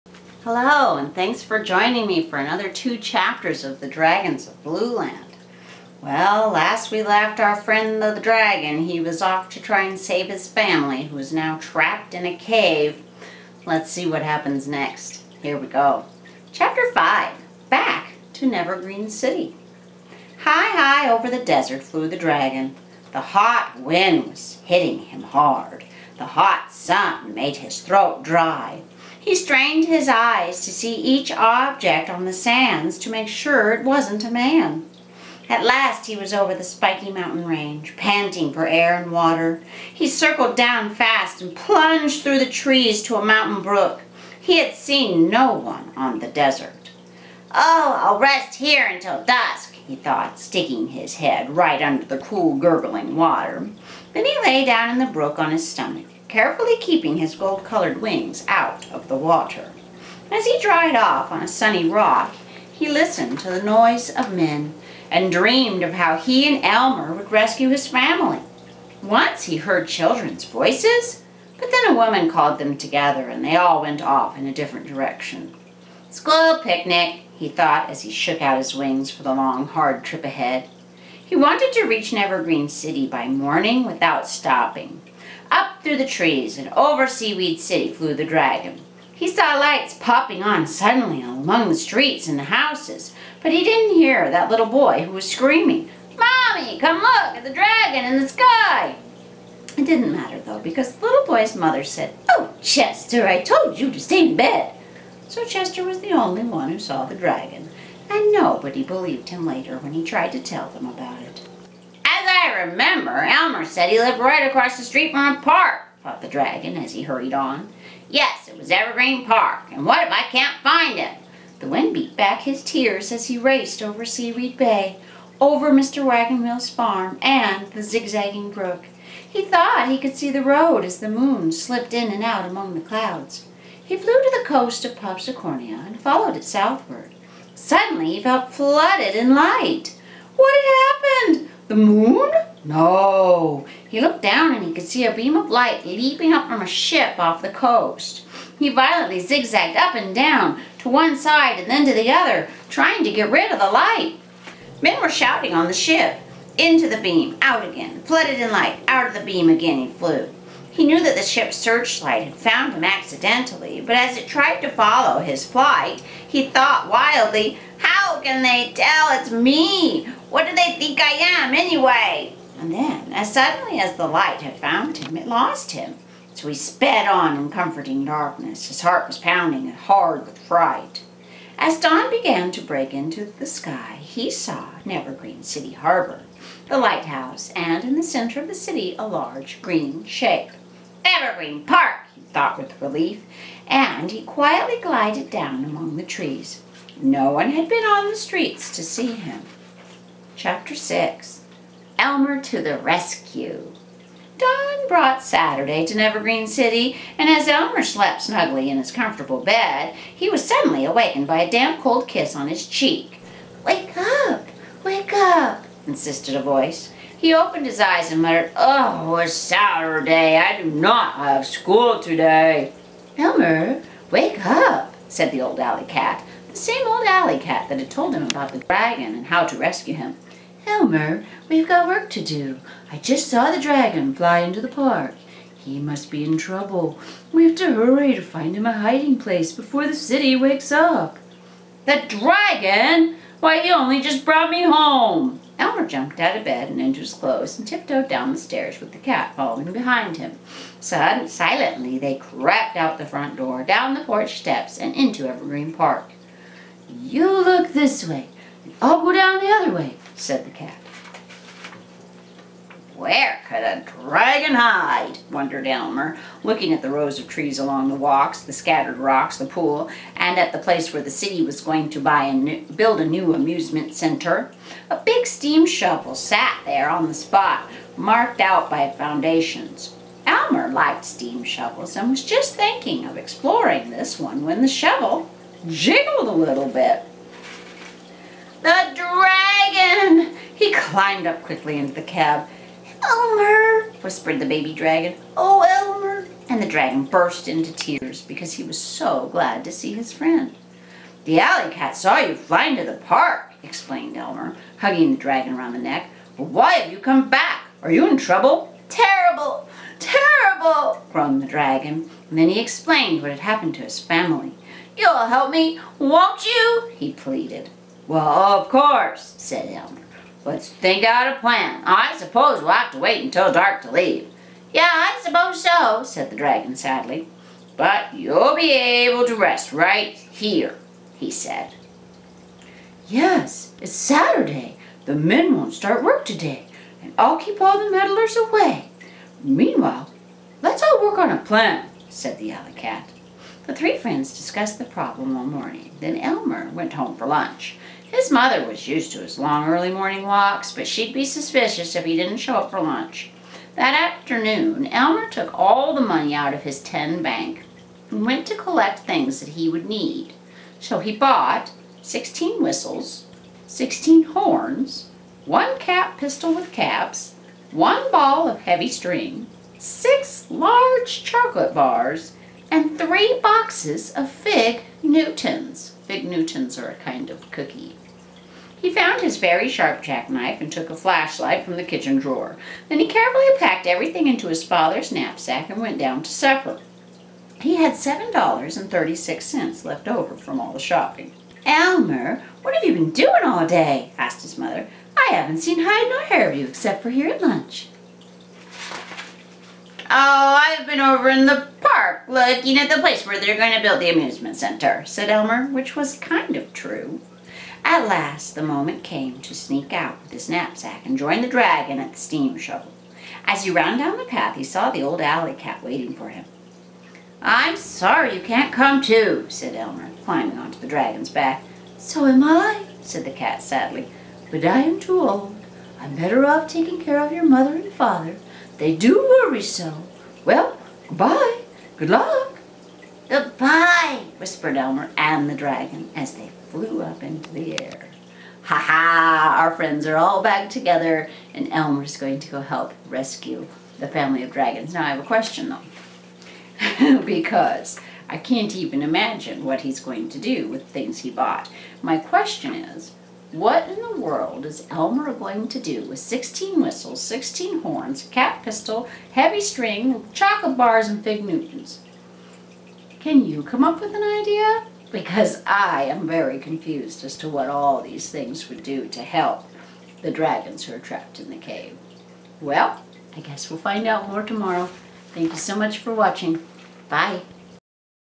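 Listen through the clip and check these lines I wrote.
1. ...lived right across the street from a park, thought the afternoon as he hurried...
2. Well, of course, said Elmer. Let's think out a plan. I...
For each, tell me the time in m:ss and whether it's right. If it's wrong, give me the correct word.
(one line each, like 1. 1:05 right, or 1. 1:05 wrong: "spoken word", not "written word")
1. 1:53 wrong: "dragon", not "afternoon"
2. 5:18 right.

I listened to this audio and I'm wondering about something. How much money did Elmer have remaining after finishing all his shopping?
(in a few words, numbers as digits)
$7.36.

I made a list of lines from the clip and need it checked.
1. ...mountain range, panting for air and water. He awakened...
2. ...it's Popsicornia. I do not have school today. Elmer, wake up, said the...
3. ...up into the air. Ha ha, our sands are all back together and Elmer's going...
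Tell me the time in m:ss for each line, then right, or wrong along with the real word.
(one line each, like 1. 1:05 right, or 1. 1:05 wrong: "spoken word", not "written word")
1. 0:37 wrong: "circled", not "awakened"
2. 3:39 wrong: "Saturday", not "Popsicornia"
3. 7:17 wrong: "friends", not "sands".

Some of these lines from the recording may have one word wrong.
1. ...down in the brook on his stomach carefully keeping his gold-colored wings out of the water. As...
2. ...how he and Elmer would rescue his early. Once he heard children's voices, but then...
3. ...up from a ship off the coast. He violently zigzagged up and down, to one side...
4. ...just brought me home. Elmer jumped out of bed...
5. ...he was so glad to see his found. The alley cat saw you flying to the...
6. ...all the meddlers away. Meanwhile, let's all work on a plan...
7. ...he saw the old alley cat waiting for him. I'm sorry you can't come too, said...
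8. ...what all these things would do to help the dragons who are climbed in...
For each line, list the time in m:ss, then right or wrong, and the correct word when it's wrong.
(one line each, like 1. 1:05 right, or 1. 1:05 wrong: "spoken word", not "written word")
1. 0:54 right
2. 1:05 wrong: "family", not "early"
3. 2:26 right
4. 4:04 right
5. 4:58 wrong: "friend", not "found"
6. 5:37 right
7. 6:54 right
8. 7:47 wrong: "trapped", not "climbed".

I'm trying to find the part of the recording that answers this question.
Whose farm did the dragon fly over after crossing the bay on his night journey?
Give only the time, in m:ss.
2:05.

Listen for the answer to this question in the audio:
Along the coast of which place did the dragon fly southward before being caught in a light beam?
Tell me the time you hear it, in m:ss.
2:14.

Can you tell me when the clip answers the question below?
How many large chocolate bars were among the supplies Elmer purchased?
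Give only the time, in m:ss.
6:09.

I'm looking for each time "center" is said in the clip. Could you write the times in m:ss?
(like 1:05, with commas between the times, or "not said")
3:08, 4:33, 6:44.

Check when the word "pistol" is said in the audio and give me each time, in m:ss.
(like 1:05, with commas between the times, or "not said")
6:06, 7:38.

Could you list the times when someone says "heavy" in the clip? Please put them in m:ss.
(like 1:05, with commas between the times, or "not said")
6:08, 7:39.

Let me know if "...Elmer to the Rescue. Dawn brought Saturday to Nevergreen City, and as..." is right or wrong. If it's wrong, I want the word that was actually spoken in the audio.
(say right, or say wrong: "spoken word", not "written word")
right.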